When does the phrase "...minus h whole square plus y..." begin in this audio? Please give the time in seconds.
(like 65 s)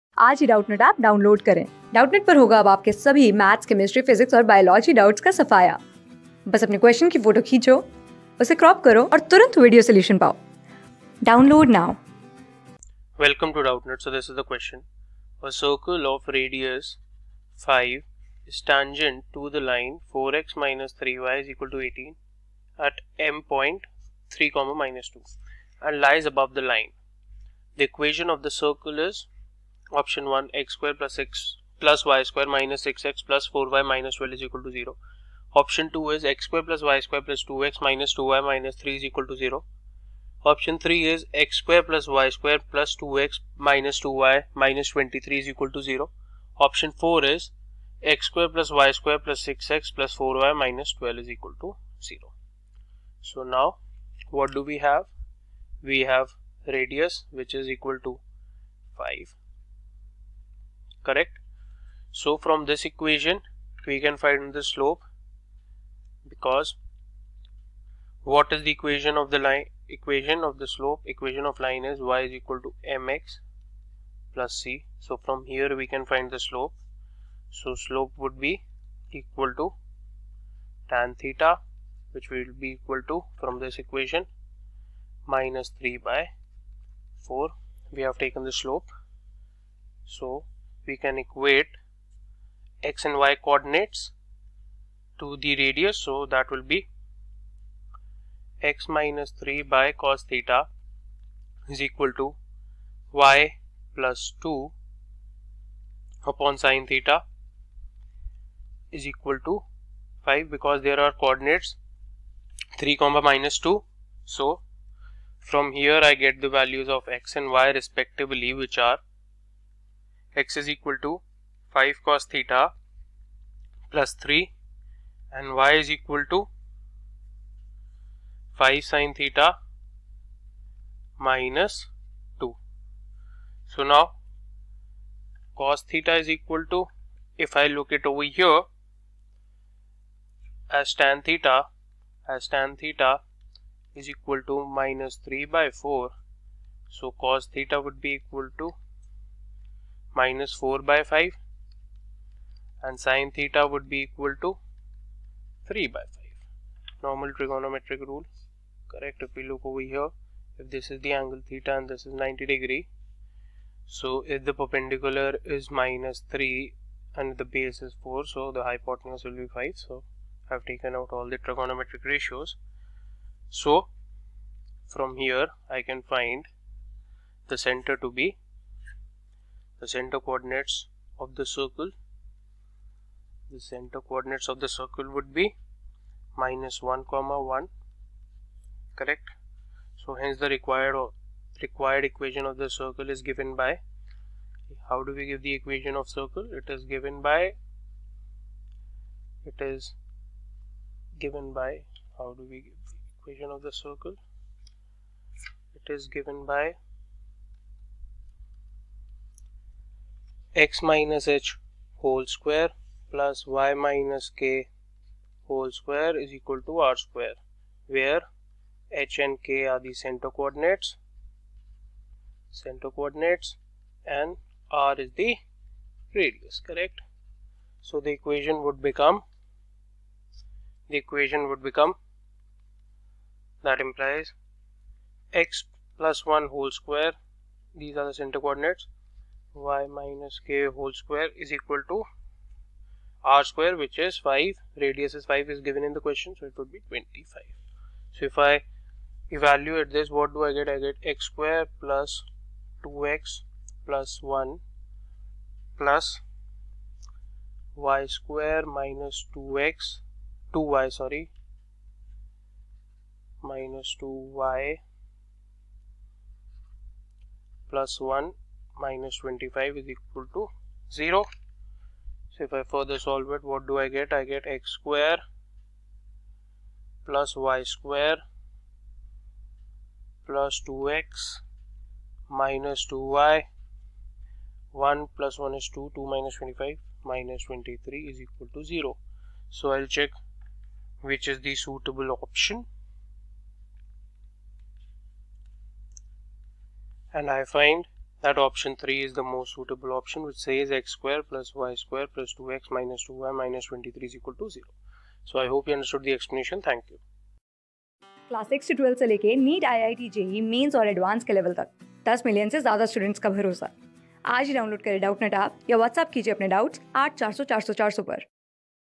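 210 s.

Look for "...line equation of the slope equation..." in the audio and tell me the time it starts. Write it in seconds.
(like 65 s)
69 s.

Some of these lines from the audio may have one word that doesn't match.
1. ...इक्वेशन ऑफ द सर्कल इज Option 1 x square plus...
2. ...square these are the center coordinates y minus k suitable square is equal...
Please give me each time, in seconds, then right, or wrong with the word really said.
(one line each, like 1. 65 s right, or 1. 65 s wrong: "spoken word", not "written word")
1. 27 s right
2. 236 s wrong: "whole", not "suitable".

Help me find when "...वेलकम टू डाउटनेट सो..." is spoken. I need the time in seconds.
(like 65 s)
13 s.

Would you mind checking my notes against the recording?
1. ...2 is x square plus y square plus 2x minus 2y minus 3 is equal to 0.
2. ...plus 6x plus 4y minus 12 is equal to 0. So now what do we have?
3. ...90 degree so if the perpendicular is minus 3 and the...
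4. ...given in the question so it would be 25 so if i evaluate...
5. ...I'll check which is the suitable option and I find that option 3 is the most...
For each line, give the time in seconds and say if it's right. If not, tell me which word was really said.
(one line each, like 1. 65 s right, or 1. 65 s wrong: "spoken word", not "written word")
1. 35 s right
2. 49 s right
3. 162 s right
4. 245 s right
5. 289 s right.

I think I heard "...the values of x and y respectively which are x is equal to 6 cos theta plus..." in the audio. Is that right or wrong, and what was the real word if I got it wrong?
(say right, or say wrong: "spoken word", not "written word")
wrong: "5", not "6".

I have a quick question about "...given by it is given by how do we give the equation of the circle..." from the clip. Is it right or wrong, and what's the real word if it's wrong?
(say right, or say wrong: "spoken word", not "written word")
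right.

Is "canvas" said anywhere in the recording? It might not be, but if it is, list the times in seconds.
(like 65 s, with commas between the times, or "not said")
not said.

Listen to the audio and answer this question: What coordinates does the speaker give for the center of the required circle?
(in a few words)
(-1, 1).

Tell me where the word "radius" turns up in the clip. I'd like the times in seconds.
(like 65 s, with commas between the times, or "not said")
56 s, 95 s, 226 s, 244 s.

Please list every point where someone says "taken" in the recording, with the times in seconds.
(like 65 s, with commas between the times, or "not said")
88 s, 170 s.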